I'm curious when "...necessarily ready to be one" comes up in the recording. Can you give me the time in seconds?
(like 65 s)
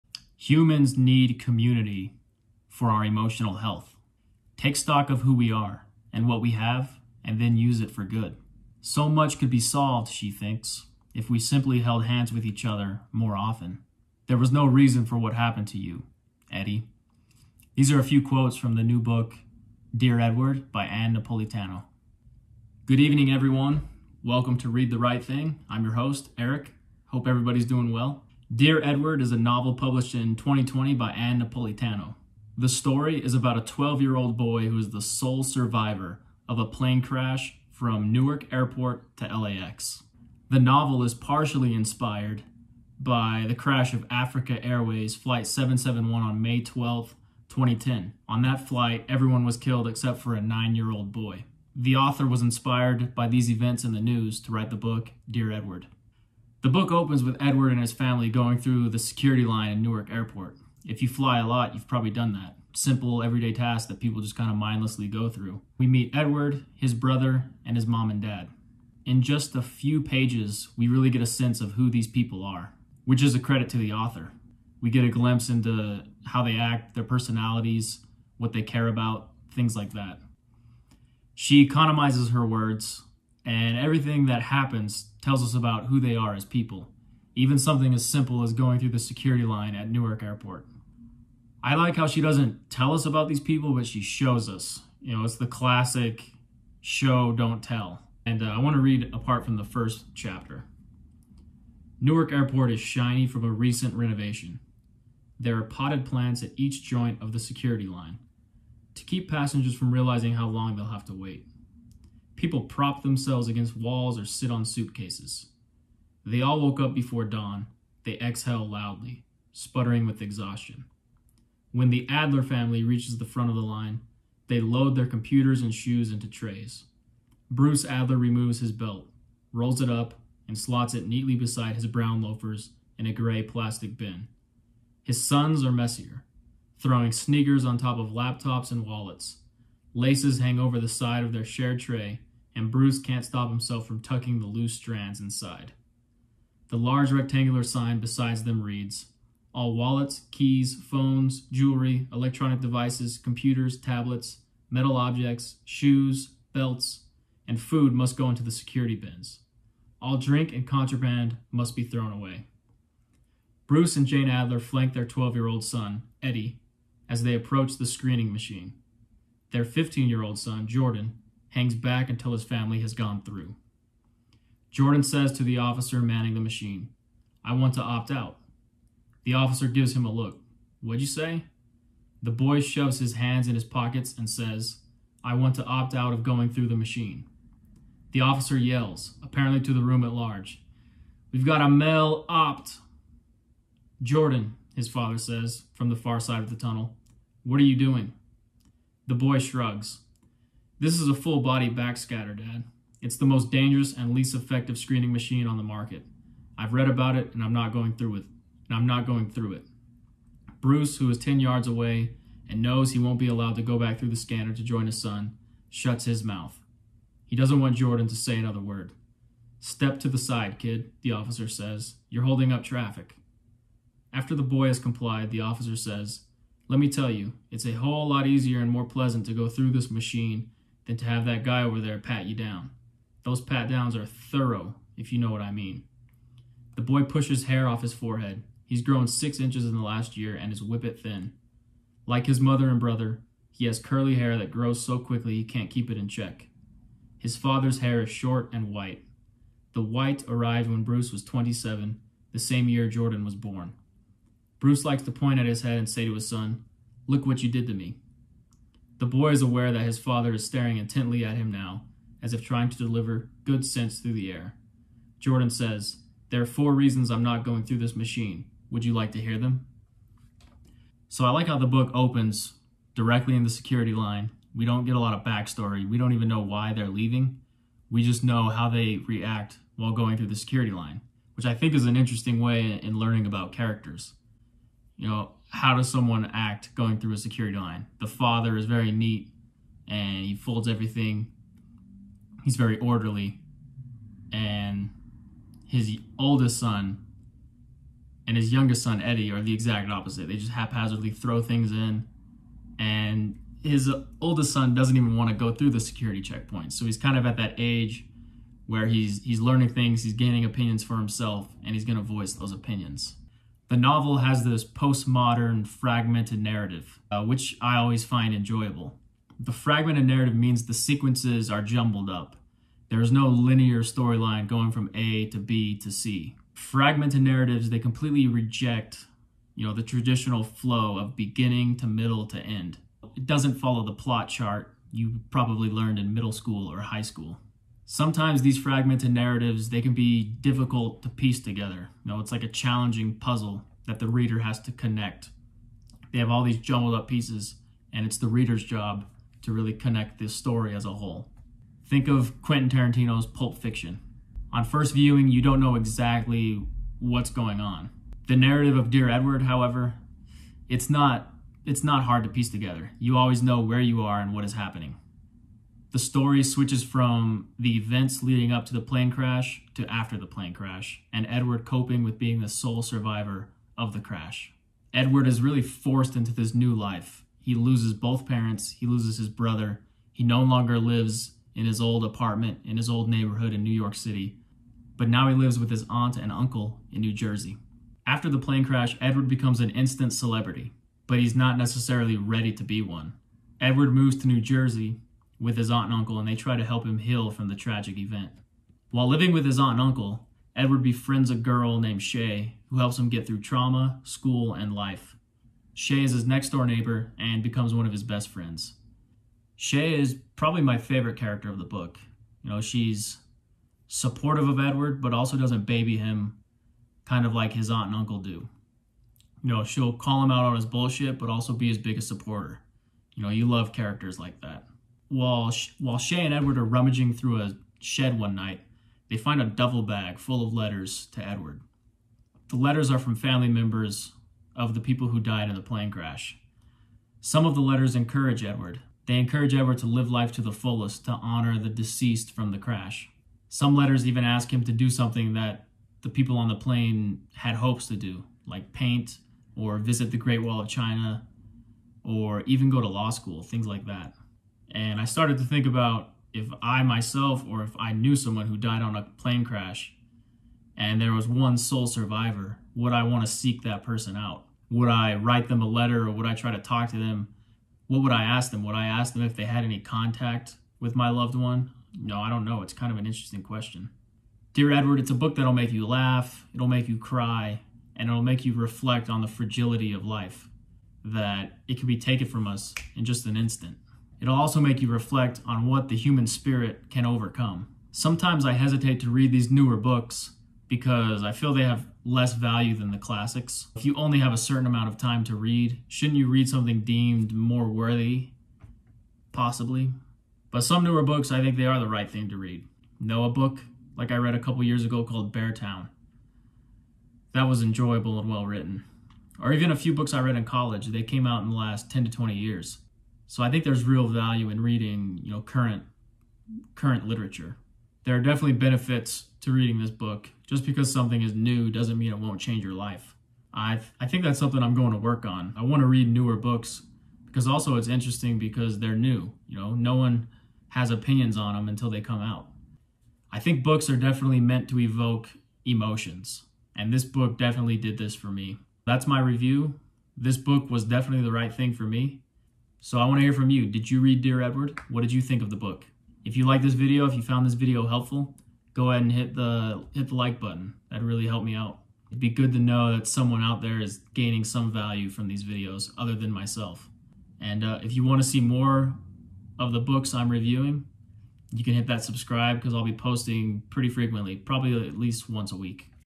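391 s.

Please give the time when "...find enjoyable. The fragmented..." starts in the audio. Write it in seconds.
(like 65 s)
318 s.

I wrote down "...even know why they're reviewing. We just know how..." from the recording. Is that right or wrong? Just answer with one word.
wrong.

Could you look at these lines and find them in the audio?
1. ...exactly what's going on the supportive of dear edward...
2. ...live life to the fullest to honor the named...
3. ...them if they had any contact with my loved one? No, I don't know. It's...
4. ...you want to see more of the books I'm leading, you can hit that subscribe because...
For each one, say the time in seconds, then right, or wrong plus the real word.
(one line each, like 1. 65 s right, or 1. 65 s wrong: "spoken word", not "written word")
1. 355 s wrong: "narrative", not "supportive"
2. 439 s wrong: "deceased", not "named"
3. 469 s right
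4. 557 s wrong: "reviewing", not "leading".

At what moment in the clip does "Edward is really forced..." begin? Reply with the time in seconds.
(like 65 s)
374 s.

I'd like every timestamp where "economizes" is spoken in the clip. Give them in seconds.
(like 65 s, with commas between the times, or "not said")
81 s.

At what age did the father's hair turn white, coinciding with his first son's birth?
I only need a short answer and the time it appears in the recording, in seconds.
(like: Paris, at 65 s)
27, at 251 s.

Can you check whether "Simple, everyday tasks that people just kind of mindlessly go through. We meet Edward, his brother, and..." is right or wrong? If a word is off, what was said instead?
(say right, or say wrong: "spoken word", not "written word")
right.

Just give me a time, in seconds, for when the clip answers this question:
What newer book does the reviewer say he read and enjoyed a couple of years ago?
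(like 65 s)
505 s.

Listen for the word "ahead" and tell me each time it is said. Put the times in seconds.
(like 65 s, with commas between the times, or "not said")
548 s.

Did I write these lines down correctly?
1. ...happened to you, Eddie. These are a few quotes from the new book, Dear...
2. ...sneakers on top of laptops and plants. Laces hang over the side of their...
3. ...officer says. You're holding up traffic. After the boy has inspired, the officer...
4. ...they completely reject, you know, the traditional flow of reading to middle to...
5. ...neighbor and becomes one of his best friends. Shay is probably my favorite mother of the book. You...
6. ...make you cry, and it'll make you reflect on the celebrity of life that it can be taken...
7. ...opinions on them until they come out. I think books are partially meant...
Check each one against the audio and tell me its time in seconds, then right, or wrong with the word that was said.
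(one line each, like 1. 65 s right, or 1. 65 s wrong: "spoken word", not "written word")
1. 15 s right
2. 137 s wrong: "wallets", not "plants"
3. 221 s wrong: "complied", not "inspired"
4. 327 s wrong: "beginning", not "reading"
5. 406 s wrong: "character", not "mother"
6. 476 s wrong: "fragility", not "celebrity"
7. 530 s wrong: "definitely", not "partially".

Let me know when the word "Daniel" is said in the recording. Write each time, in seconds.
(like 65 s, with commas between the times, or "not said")
not said.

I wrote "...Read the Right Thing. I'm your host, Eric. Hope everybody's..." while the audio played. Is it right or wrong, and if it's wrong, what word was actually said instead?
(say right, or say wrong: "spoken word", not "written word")
right.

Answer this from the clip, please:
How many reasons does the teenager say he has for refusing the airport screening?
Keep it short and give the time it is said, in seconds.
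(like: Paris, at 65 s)
4, at 266 s.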